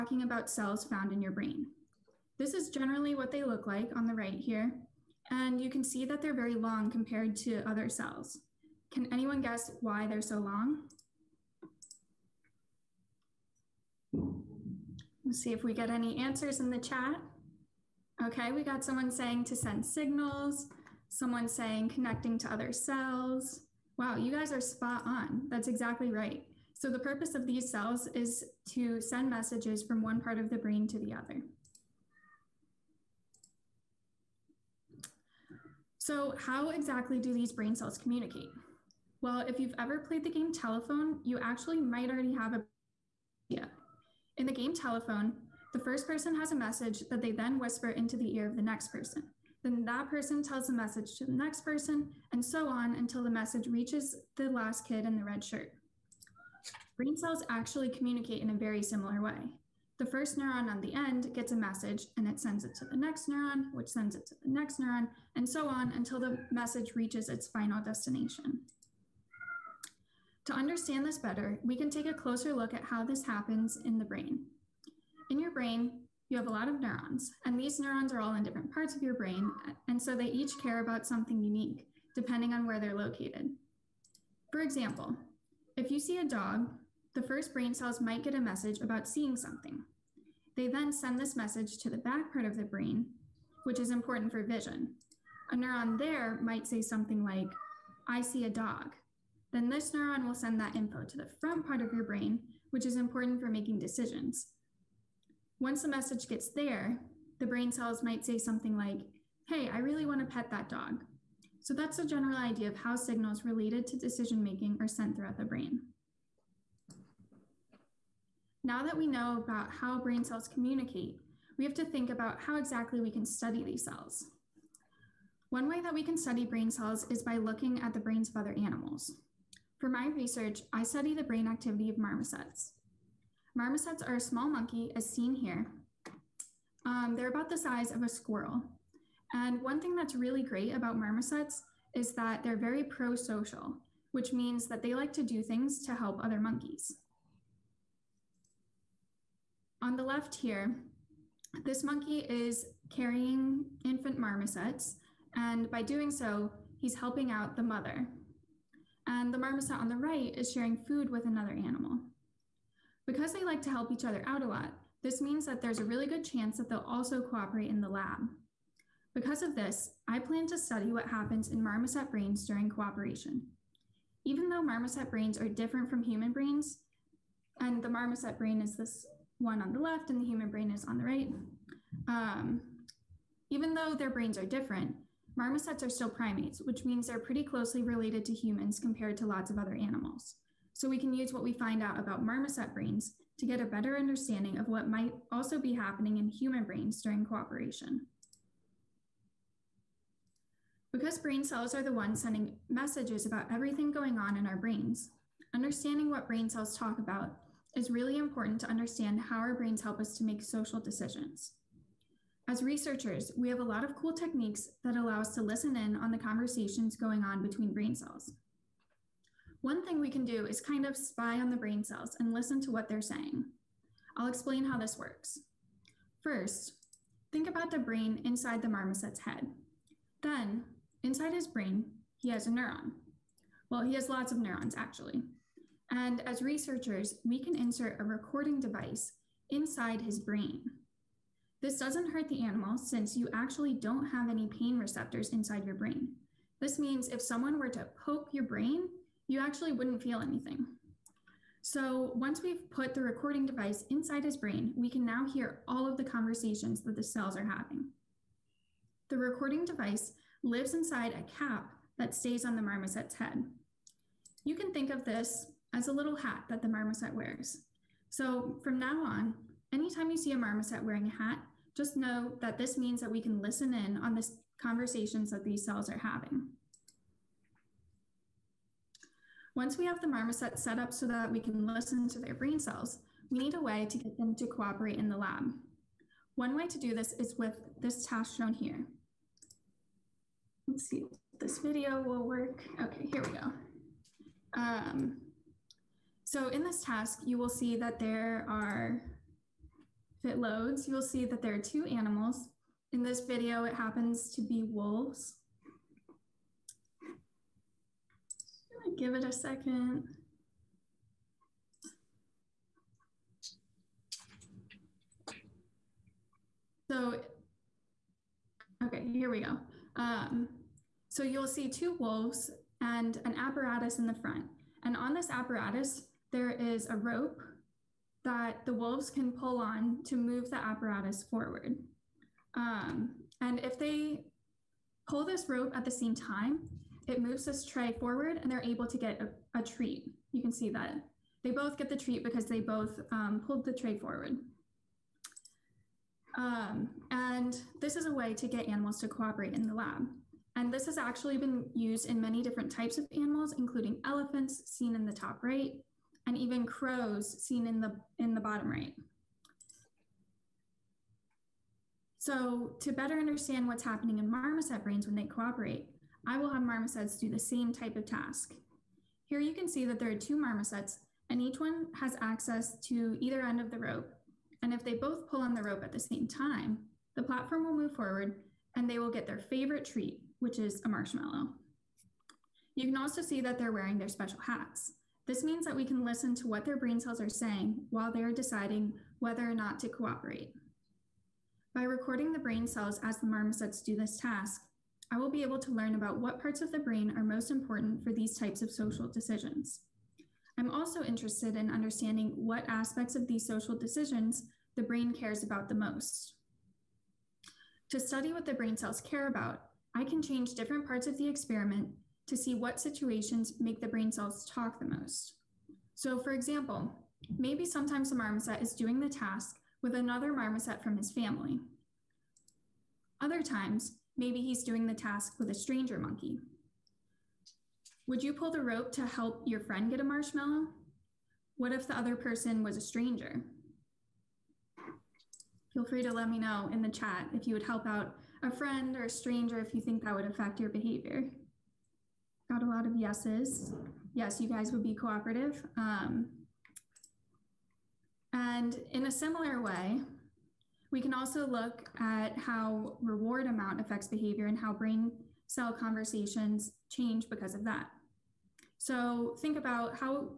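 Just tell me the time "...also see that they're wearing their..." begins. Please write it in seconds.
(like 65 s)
382 s.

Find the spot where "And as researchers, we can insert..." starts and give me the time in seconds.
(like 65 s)
235 s.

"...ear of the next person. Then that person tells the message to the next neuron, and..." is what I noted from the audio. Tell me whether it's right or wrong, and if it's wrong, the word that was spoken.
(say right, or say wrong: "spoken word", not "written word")
wrong: "person", not "neuron".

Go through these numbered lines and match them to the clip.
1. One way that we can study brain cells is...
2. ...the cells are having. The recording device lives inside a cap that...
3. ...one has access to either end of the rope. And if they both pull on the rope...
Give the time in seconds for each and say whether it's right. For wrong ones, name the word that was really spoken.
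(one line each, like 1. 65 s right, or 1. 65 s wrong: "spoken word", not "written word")
1. 125 s right
2. 256 s right
3. 371 s right.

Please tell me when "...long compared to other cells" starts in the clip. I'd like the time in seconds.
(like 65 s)
6 s.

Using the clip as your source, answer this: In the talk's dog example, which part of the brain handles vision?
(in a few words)
back part.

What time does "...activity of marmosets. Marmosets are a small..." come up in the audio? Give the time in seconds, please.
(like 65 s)
131 s.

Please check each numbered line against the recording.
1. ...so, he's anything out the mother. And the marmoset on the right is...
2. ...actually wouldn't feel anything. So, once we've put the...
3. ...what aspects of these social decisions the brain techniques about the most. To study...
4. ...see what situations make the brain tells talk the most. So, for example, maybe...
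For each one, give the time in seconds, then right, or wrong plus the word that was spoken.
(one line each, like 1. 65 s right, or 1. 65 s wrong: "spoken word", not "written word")
1. 156 s wrong: "helping", not "anything"
2. 249 s right
3. 402 s wrong: "cares", not "techniques"
4. 412 s wrong: "cells", not "tells".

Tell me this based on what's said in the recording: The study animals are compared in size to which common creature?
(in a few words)
a squirrel.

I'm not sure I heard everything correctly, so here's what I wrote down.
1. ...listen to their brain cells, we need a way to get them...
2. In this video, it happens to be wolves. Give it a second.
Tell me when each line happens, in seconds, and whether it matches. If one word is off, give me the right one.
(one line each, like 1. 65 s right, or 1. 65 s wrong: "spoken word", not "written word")
1. 281 s right
2. 302 s right.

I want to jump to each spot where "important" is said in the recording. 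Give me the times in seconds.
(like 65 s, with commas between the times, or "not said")
93 s, 102 s, 208 s, 397 s.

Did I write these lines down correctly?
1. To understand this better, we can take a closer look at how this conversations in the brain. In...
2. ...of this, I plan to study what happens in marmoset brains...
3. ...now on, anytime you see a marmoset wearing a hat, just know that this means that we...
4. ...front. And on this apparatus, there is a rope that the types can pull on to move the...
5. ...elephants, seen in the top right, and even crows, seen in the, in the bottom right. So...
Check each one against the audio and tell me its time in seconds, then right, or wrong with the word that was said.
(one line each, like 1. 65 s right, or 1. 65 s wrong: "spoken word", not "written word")
1. 70 s wrong: "happens", not "conversations"
2. 169 s right
3. 268 s right
4. 324 s wrong: "wolves", not "types"
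5. 354 s right.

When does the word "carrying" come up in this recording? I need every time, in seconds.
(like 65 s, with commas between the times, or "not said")
152 s.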